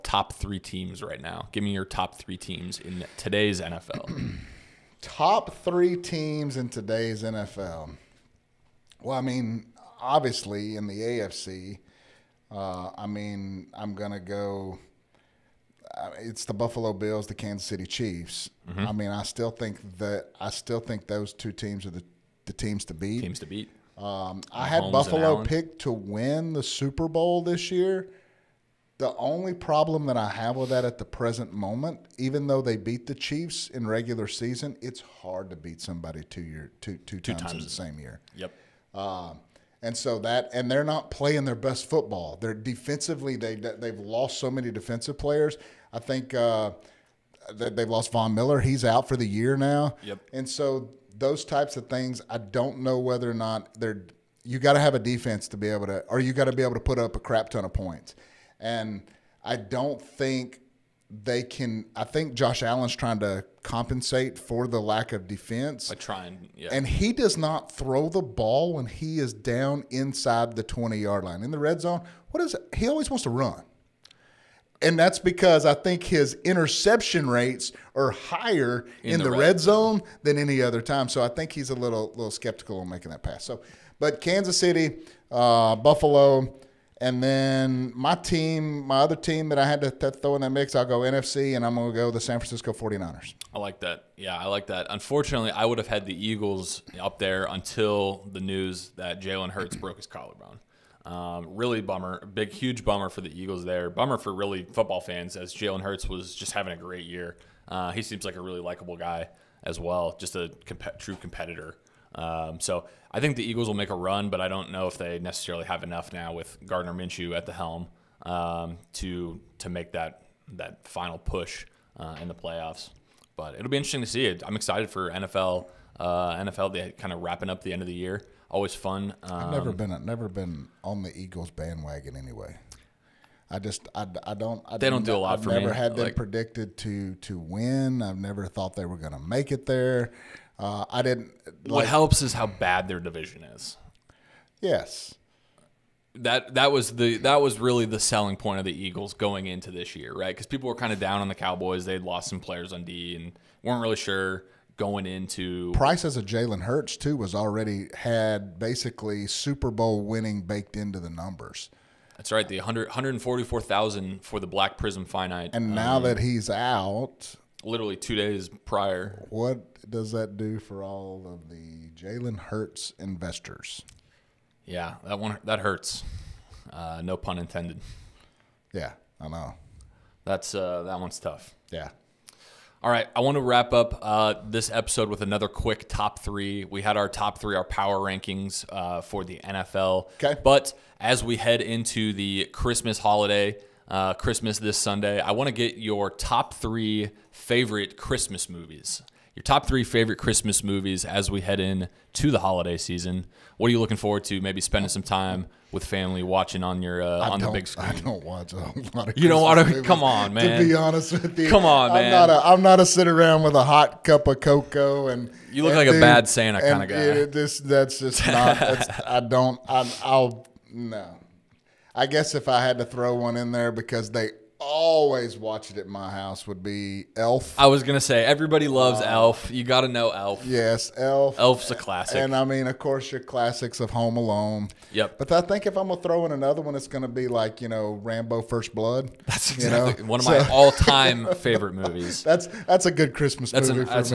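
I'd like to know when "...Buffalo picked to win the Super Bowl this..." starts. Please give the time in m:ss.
0:24.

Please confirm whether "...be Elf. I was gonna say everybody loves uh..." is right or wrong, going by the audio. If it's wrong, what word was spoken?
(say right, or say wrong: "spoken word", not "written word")
right.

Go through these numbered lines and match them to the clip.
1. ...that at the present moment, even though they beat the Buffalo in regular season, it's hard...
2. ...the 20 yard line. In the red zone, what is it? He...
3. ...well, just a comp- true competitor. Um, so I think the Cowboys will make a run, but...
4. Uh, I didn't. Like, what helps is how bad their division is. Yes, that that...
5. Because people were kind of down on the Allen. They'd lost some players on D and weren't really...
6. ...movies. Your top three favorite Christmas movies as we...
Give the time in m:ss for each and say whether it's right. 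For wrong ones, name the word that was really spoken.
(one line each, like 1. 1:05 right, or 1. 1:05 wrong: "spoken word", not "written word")
1. 0:30 wrong: "Chiefs", not "Buffalo"
2. 1:10 right
3. 1:49 wrong: "Eagles", not "Cowboys"
4. 2:20 right
5. 2:30 wrong: "Cowboys", not "Allen"
6. 3:18 right.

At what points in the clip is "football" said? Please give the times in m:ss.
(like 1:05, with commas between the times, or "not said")
0:41, 1:44.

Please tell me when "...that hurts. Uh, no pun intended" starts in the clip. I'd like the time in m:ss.
2:55.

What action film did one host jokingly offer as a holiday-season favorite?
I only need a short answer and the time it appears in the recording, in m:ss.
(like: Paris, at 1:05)
Rambo: First Blood, at 3:58.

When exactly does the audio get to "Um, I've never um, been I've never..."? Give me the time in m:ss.
2:09.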